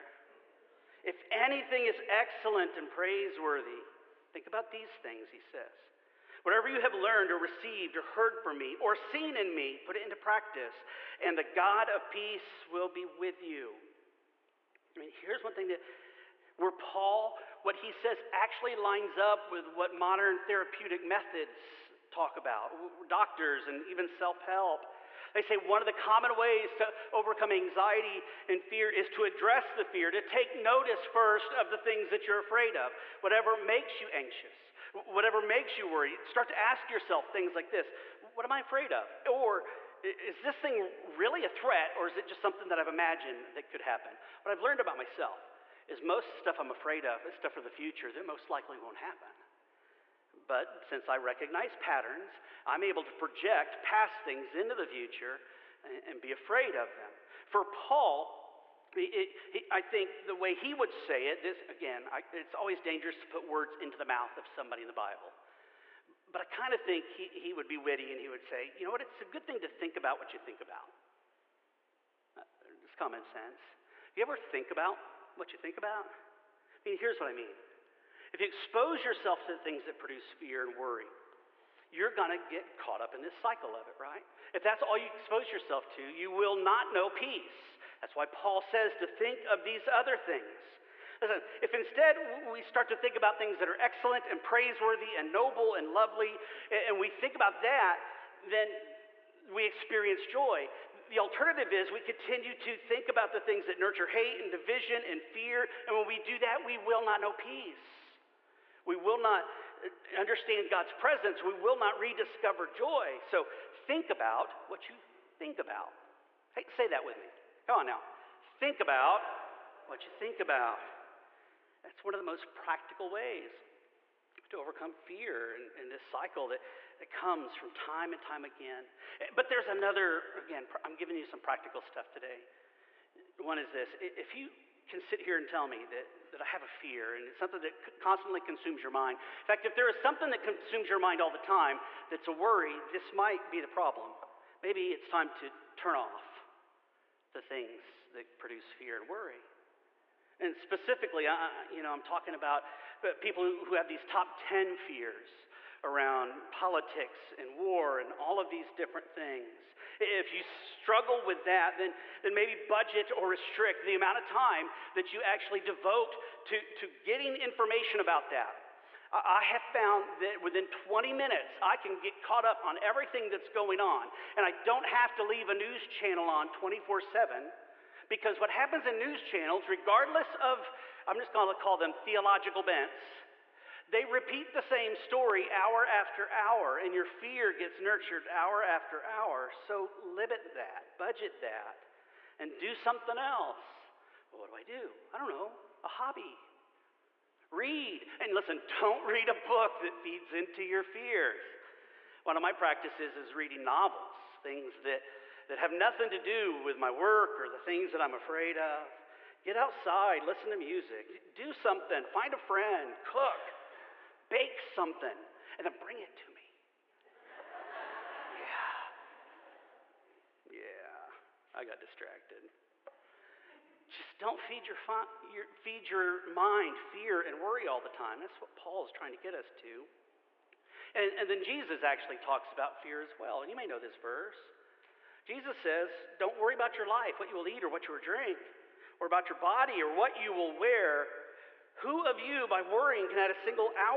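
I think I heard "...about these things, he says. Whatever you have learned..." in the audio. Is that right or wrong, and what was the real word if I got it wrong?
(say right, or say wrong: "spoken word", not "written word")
right.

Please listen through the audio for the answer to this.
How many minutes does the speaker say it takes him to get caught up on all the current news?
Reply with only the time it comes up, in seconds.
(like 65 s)
170 s.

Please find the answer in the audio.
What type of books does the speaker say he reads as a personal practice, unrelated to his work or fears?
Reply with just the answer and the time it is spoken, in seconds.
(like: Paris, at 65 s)
Novels, at 203 s.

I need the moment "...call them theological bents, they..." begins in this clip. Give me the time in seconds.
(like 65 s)
181 s.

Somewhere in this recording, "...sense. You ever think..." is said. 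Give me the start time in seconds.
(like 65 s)
73 s.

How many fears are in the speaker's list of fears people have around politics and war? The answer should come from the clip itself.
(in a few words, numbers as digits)
10.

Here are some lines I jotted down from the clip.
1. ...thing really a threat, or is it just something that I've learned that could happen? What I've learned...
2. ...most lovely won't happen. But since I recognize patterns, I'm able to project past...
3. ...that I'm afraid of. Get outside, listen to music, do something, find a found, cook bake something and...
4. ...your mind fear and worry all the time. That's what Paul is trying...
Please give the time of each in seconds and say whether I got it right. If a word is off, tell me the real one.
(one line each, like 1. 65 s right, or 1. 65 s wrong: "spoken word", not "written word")
1. 40 s wrong: "imagined", not "learned"
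2. 48 s wrong: "likely", not "lovely"
3. 207 s wrong: "friend", not "found"
4. 225 s right.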